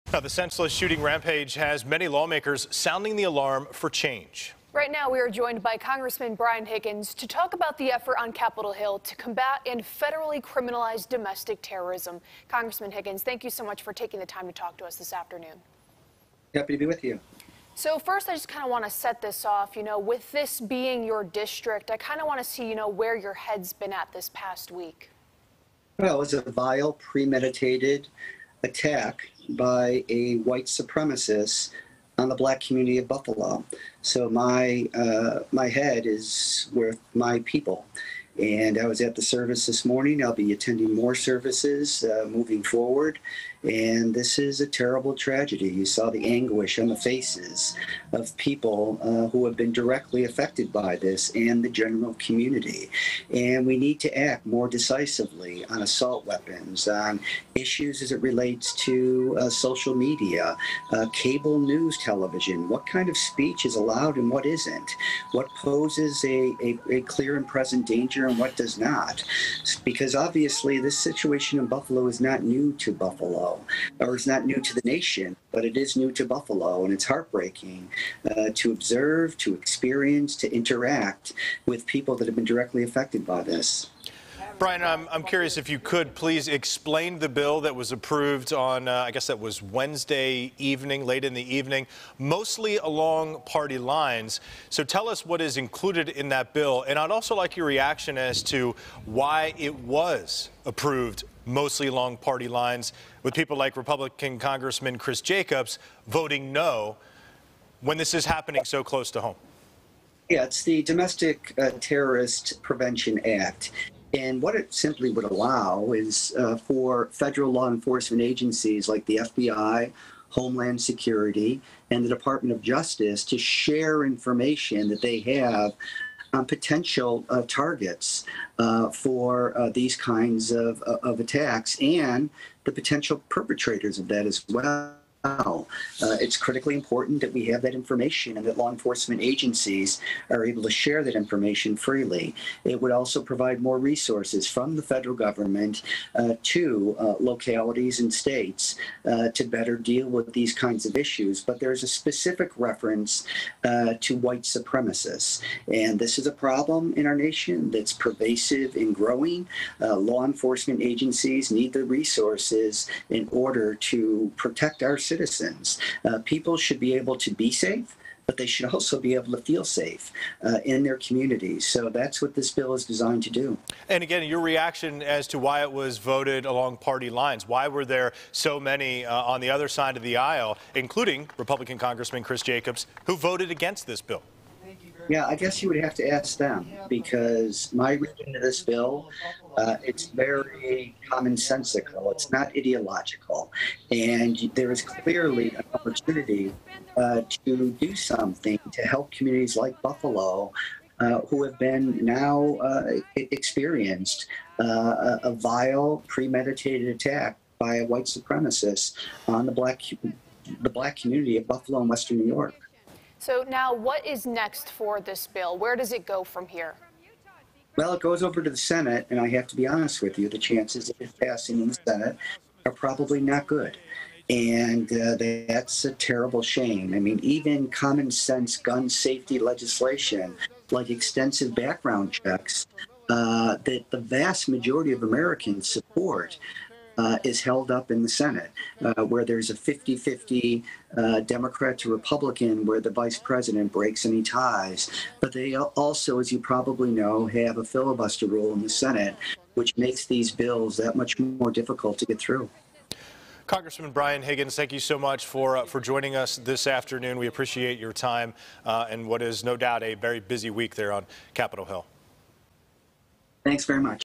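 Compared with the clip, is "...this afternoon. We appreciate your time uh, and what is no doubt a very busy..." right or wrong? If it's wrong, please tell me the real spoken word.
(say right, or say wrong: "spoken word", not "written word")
right.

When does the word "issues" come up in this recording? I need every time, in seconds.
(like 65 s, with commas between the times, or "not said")
57 s, 150 s.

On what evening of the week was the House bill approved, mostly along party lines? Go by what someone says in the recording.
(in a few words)
Wednesday.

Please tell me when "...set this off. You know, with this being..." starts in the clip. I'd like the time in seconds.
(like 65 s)
18 s.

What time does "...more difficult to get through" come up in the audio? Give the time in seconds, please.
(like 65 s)
251 s.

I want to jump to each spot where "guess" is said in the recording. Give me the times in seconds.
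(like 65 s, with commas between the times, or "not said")
89 s, 185 s.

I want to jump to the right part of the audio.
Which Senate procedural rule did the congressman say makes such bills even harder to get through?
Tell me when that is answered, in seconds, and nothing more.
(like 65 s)
247 s.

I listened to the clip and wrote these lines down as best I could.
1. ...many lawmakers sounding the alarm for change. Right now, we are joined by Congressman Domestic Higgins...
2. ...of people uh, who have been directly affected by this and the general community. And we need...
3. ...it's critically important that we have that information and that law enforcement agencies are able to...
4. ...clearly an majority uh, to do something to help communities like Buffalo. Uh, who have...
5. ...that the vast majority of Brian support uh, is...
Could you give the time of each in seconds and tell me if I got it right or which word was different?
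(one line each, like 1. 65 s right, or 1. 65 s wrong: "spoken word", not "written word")
1. 1 s wrong: "Brian", not "Domestic"
2. 48 s right
3. 136 s right
4. 194 s wrong: "opportunity", not "majority"
5. 233 s wrong: "Americans", not "Brian".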